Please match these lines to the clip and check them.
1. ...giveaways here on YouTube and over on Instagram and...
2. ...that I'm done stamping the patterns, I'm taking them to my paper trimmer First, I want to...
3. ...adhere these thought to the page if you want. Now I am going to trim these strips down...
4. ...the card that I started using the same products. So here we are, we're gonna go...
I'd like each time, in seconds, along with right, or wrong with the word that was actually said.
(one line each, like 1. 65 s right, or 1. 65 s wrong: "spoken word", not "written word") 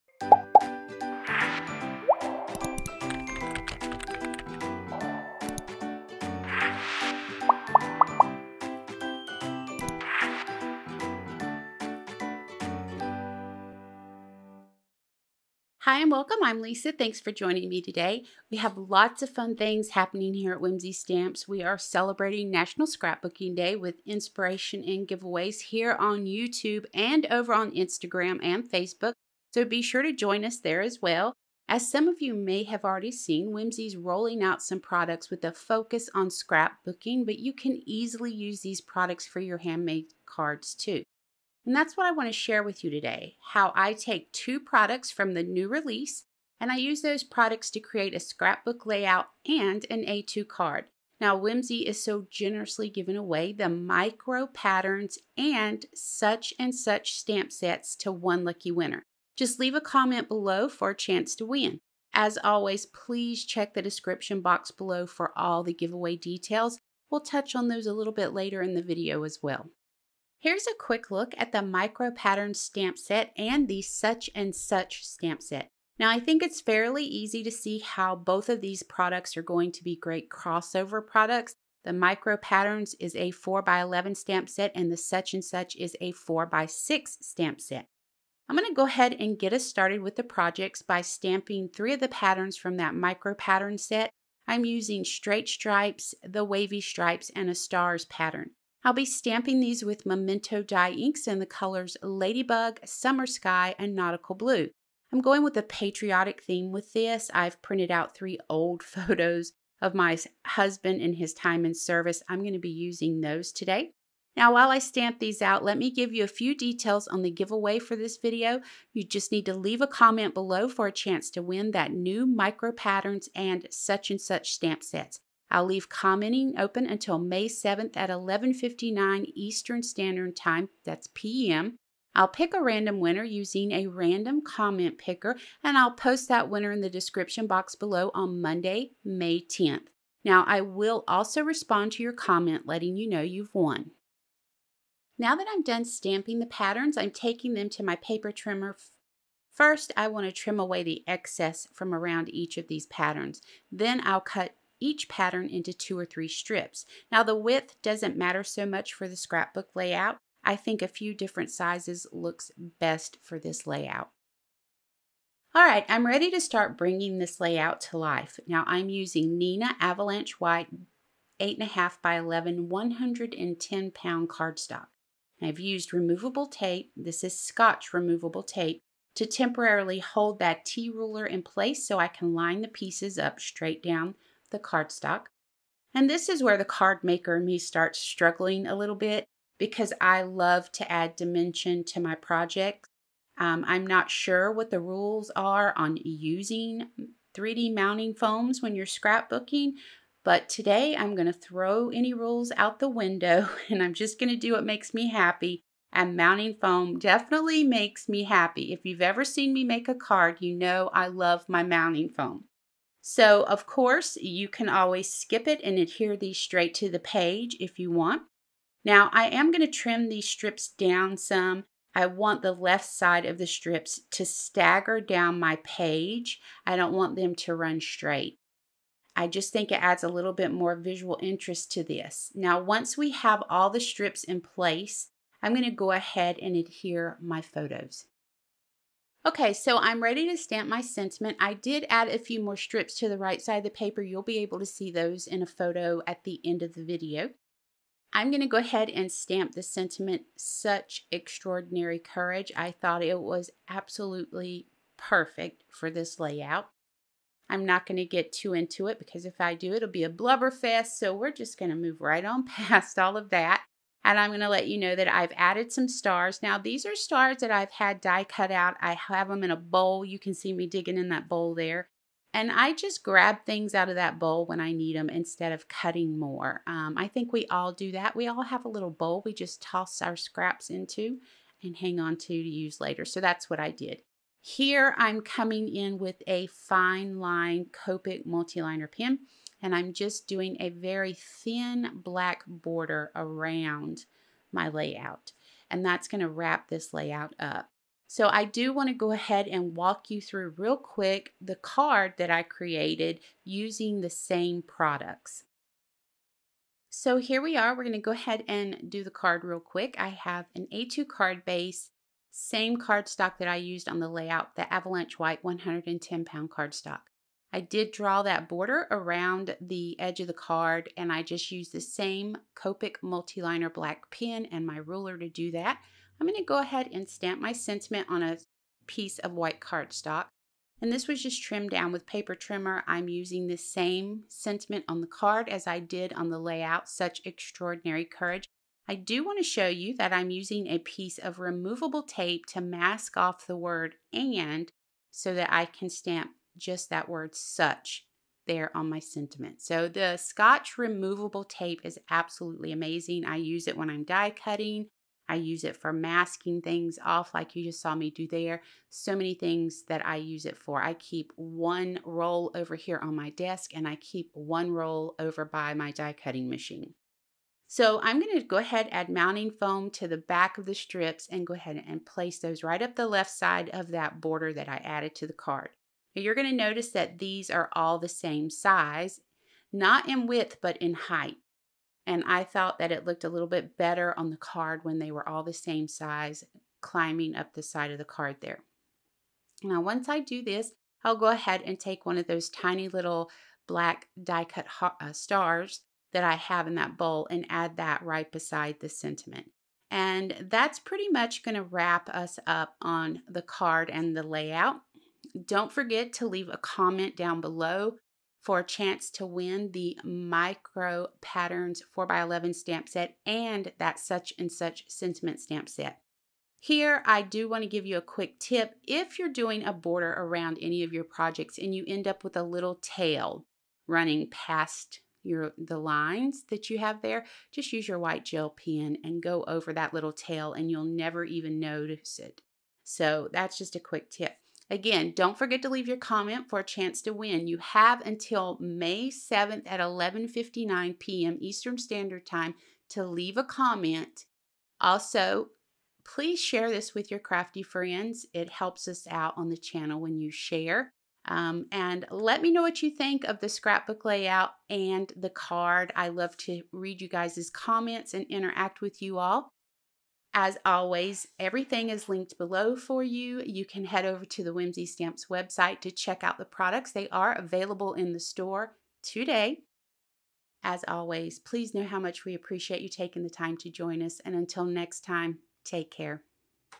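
1. 25 s right
2. 145 s right
3. 215 s wrong: "straight", not "thought"
4. 301 s wrong: "created", not "started".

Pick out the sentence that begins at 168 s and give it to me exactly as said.
Now I'm using Neenah Avalanche White 8.5 by 11 110 pound cardstock.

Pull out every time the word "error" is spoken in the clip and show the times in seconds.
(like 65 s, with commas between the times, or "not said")
not said.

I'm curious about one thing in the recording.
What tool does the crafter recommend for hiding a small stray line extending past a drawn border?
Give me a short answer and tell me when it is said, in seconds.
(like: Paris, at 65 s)
white gel pen, at 427 s.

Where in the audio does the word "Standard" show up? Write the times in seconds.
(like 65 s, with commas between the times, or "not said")
129 s, 441 s.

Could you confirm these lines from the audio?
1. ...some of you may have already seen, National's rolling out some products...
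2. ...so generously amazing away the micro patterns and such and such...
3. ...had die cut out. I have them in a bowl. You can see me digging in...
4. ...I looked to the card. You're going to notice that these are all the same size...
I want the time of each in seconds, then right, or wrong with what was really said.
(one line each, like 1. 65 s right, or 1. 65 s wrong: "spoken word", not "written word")
1. 31 s wrong: "Whimsy", not "National"
2. 52 s wrong: "giving", not "amazing"
3. 267 s right
4. 374 s wrong: "added", not "looked".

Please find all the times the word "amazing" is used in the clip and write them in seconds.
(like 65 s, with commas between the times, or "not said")
352 s.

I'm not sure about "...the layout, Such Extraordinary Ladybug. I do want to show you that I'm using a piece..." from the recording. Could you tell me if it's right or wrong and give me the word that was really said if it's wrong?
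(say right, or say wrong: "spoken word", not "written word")
wrong: "Courage", not "Ladybug".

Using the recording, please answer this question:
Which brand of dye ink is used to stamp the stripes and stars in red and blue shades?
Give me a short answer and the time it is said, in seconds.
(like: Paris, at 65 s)
Memento, at 100 s.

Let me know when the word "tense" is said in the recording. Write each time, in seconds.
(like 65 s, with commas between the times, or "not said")
not said.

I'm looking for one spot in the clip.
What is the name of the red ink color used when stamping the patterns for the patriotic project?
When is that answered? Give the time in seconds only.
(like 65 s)
102 s.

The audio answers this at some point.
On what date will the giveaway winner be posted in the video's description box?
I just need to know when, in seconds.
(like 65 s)
138 s.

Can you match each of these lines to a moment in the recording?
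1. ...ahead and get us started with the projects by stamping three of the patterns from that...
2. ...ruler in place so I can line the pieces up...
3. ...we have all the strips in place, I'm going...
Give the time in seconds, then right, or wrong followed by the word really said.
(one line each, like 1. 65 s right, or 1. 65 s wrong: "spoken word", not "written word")
1. 88 s right
2. 180 s right
3. 232 s right.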